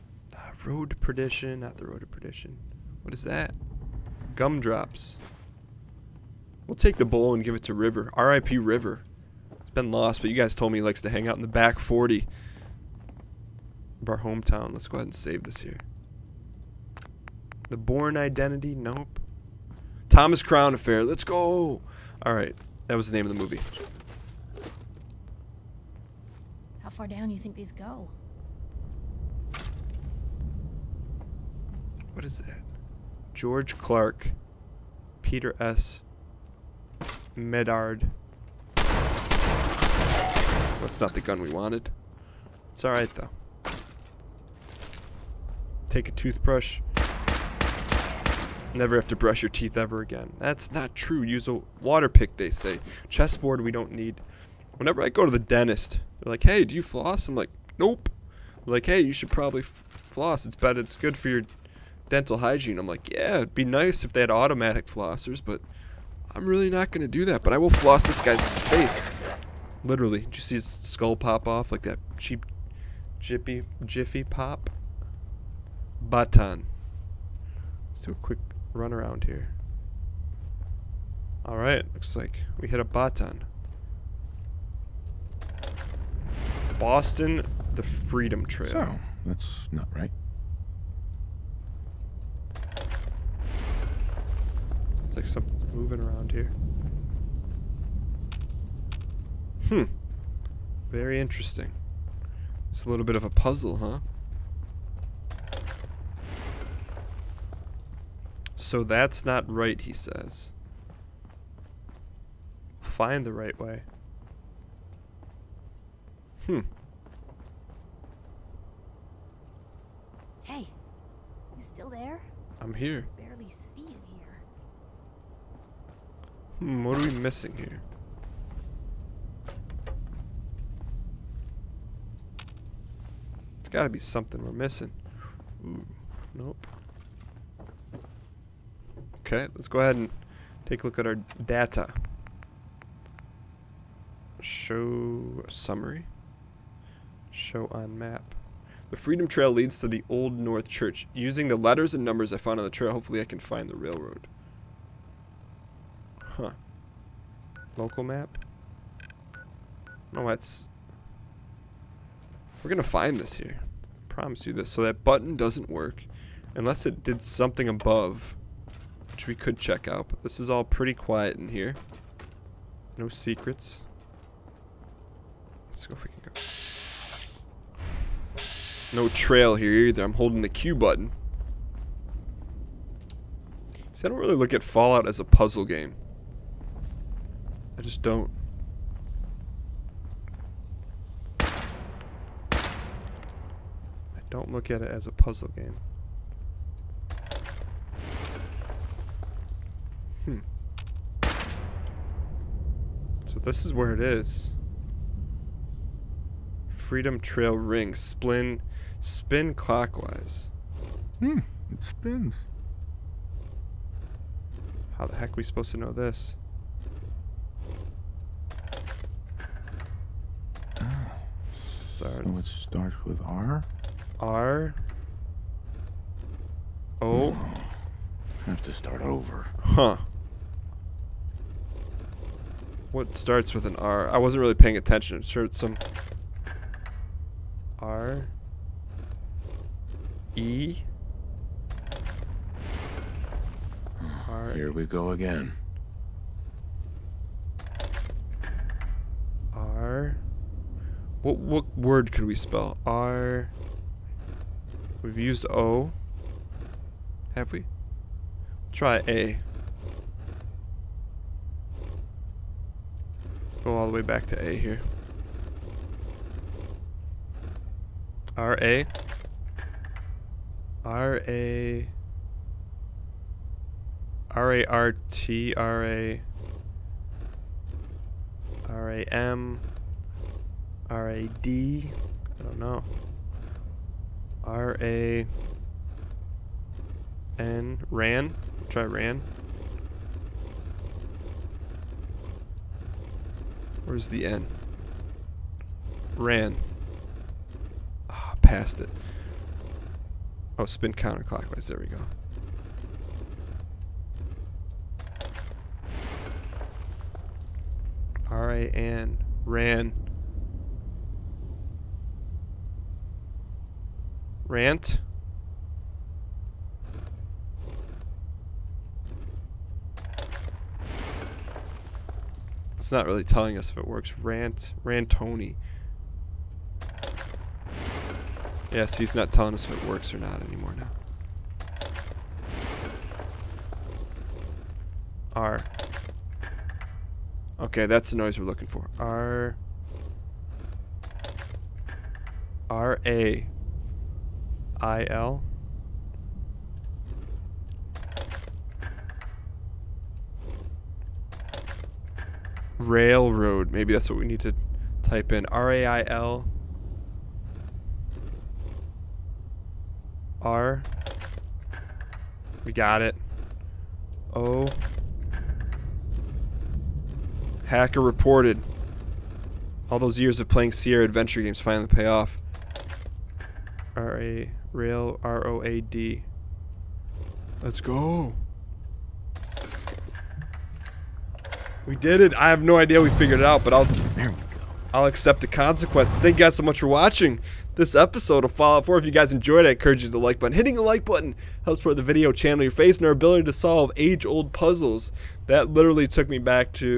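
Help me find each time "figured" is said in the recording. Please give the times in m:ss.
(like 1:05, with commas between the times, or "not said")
6:23.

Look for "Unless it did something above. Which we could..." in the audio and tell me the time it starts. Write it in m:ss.
2:46.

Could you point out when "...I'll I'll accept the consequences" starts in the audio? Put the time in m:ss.
6:23.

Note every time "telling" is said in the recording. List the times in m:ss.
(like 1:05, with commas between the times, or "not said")
5:23, 5:29.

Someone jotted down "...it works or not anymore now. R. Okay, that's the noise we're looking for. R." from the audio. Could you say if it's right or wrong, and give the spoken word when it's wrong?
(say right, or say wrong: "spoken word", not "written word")
right.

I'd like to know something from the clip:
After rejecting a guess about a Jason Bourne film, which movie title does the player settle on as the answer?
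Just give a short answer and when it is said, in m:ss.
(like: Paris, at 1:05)
Thomas Crown Affair, at 0:20.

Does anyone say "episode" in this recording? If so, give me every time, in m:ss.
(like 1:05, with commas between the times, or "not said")
6:27.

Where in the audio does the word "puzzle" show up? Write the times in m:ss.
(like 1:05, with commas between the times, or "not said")
1:43, 3:05, 3:15, 6:34.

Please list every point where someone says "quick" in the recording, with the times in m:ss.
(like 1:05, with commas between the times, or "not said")
1:18.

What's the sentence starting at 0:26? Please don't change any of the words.
How far down do you think these go?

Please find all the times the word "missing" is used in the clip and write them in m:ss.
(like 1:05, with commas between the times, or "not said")
2:07, 2:14.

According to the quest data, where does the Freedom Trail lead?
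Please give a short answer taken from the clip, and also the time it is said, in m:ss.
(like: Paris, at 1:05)
Old North Church, at 2:30.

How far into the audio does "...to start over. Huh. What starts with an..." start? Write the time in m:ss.
3:48.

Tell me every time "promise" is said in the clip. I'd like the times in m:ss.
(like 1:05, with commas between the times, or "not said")
2:44.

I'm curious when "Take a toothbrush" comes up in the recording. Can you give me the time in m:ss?
0:45.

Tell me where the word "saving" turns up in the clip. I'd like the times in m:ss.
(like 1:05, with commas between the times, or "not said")
not said.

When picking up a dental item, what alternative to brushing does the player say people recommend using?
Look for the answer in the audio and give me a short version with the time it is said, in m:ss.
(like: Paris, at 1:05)
water pick, at 0:51.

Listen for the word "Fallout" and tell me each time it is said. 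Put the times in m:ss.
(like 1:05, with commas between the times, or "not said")
3:04, 6:28.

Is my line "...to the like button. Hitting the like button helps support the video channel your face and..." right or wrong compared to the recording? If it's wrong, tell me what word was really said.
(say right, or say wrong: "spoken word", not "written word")
right.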